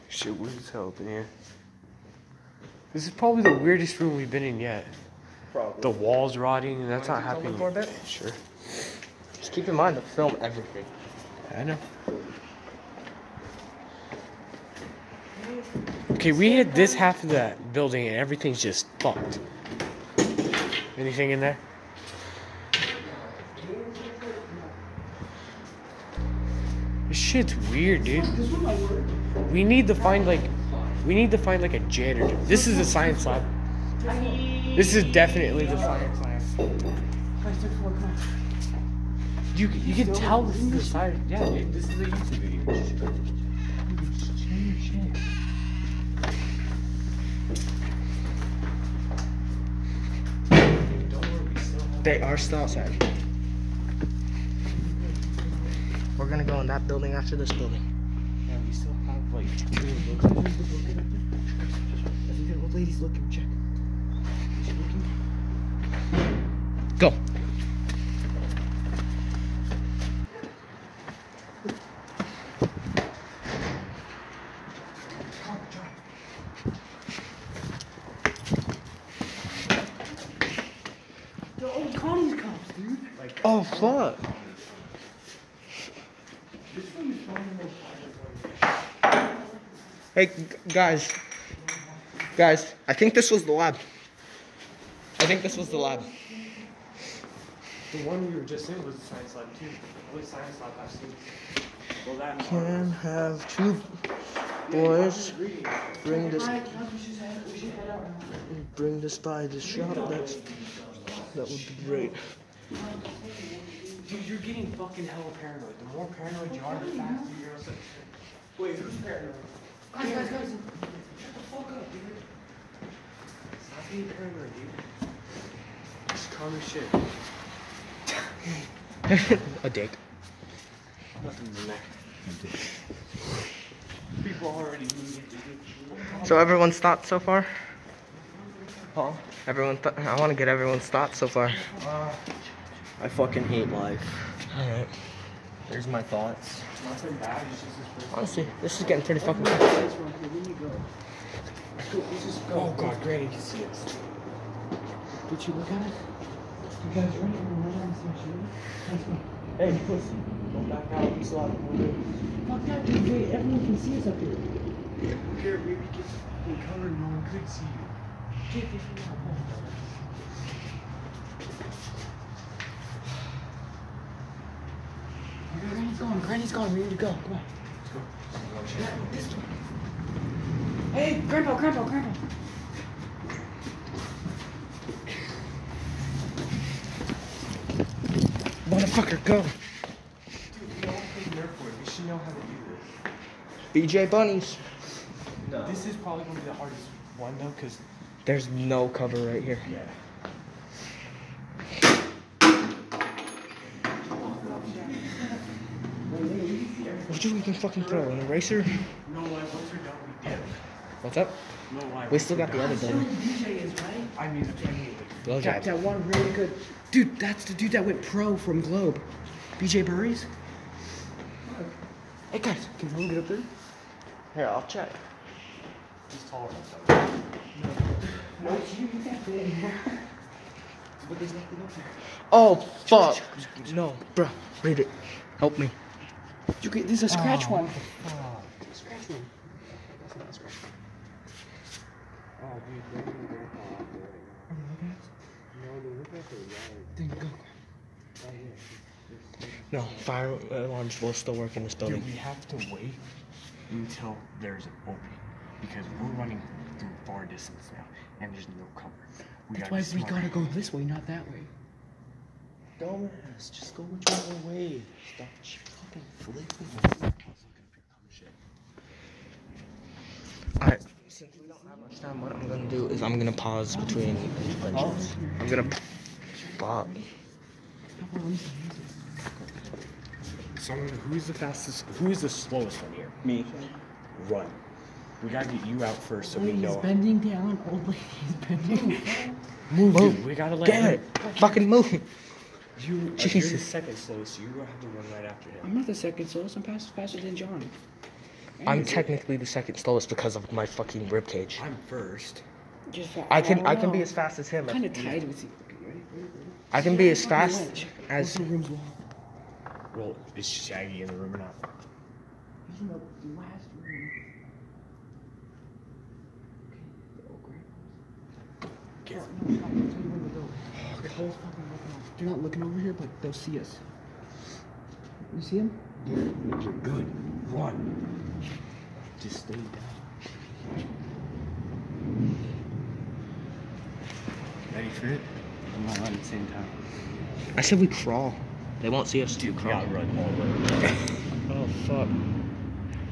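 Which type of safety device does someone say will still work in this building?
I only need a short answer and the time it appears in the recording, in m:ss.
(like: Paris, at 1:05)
fire alarms, at 4:09.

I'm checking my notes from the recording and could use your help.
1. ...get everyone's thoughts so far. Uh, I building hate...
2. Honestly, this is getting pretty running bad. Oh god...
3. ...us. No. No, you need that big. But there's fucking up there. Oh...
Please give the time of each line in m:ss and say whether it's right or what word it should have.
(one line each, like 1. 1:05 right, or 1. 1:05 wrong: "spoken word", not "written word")
1. 2:20 wrong: "fucking", not "building"
2. 2:28 wrong: "fucking", not "running"
3. 3:46 wrong: "nothing", not "fucking".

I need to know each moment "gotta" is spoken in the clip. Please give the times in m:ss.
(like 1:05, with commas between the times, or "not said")
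4:20, 4:45, 4:50.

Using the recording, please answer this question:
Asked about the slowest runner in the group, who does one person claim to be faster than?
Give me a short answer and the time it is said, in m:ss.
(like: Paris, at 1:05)
John, at 4:56.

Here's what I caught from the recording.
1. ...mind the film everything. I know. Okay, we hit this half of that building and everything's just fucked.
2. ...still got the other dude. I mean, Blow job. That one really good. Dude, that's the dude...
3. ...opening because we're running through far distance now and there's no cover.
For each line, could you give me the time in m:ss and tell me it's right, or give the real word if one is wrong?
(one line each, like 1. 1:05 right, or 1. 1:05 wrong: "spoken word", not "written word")
1. 0:09 right
2. 3:32 right
3. 4:14 right.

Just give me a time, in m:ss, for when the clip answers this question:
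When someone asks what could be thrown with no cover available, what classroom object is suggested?
3:28.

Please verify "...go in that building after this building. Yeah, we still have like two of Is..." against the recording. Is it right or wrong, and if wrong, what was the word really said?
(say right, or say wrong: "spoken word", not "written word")
right.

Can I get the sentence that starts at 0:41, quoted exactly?
Yeah, dude, this is a YouTube video.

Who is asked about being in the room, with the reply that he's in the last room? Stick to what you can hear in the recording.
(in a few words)
Shaggy.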